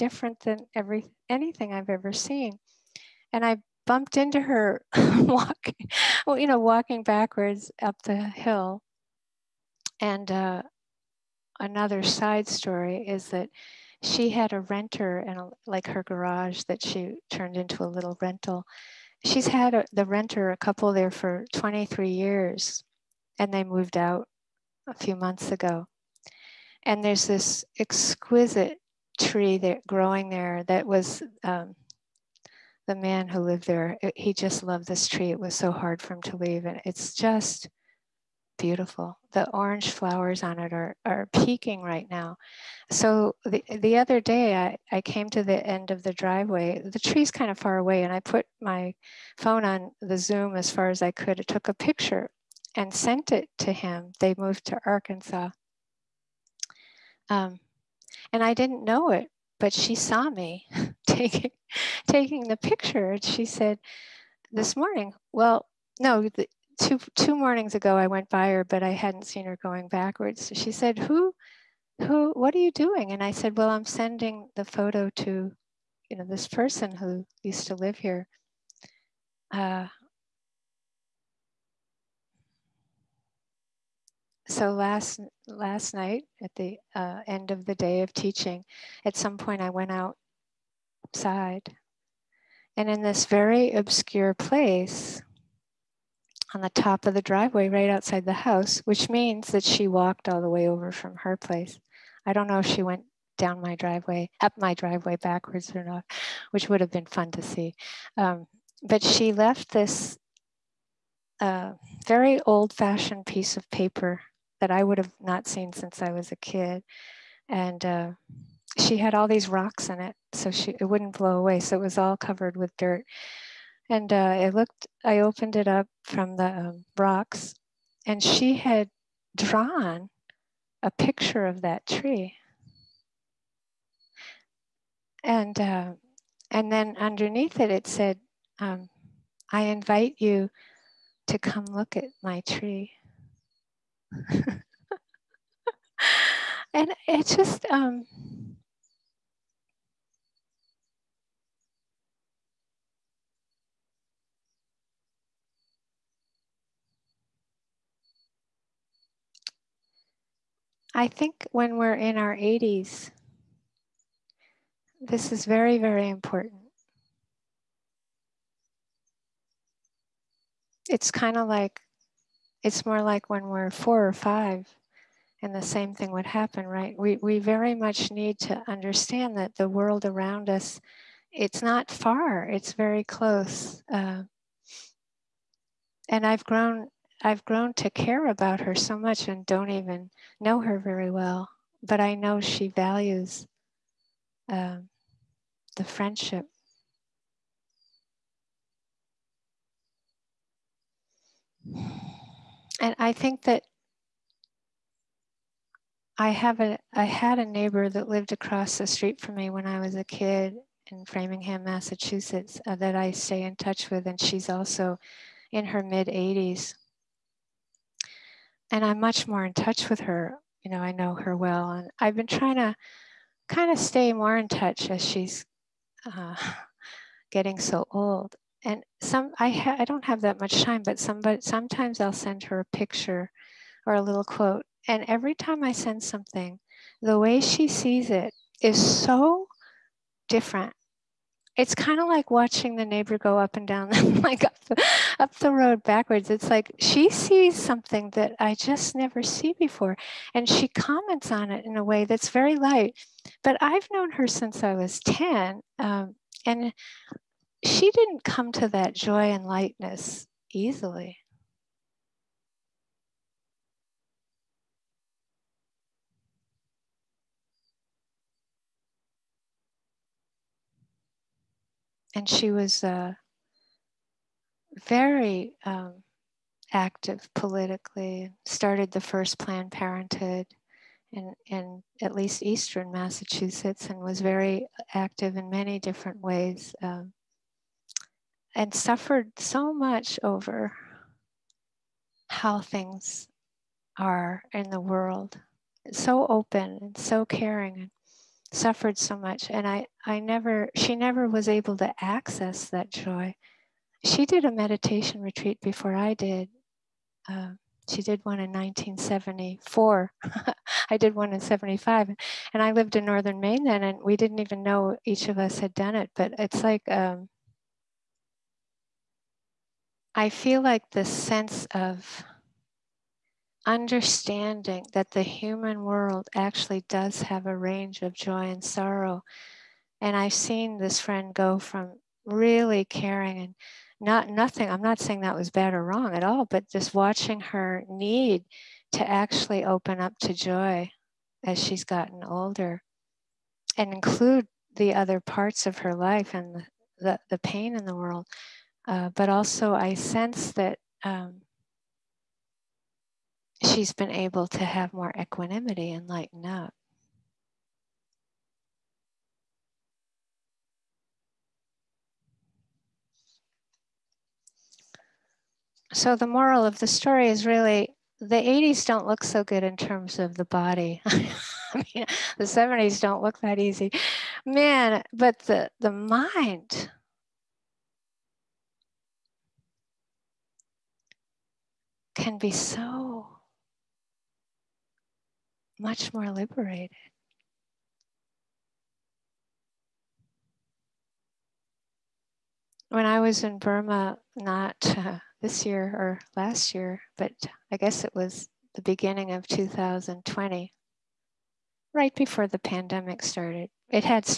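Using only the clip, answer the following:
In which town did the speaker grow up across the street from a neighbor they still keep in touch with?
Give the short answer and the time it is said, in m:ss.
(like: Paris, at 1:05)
Framingham, at 3:31.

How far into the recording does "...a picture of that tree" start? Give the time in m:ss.
2:10.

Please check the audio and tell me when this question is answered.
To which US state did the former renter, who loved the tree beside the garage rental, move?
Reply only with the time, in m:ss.
0:54.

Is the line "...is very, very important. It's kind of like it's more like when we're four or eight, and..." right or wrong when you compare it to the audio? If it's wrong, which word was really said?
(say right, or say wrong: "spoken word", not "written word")
wrong: "five", not "eight".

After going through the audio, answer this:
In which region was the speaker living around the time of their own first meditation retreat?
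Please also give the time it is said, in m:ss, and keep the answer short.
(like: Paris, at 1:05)
Northern Maine, at 5:13.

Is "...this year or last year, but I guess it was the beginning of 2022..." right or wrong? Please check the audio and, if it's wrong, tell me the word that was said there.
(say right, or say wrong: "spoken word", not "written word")
wrong: "2020", not "2022".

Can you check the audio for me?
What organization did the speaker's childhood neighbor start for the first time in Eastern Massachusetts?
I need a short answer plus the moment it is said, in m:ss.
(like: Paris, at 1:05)
Planned Parenthood, at 4:39.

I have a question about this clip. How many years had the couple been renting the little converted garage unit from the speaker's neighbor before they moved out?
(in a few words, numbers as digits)
23.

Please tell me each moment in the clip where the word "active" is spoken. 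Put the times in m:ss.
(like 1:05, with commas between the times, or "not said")
4:36, 4:44.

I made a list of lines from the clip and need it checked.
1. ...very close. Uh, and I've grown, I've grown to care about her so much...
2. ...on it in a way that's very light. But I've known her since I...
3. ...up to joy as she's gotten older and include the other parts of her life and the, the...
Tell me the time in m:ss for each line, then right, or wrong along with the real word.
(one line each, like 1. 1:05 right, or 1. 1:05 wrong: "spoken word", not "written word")
1. 3:02 right
2. 4:11 right
3. 5:39 right.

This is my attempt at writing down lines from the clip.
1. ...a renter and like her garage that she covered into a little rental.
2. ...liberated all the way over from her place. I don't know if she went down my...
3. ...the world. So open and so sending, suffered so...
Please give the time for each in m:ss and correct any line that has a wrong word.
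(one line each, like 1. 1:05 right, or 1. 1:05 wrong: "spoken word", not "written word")
1. 0:14 wrong: "turned", not "covered"
2. 1:39 wrong: "walked", not "liberated"
3. 4:54 wrong: "caring", not "sending".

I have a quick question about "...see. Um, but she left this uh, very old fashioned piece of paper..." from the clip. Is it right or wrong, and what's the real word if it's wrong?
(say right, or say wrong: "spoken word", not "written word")
right.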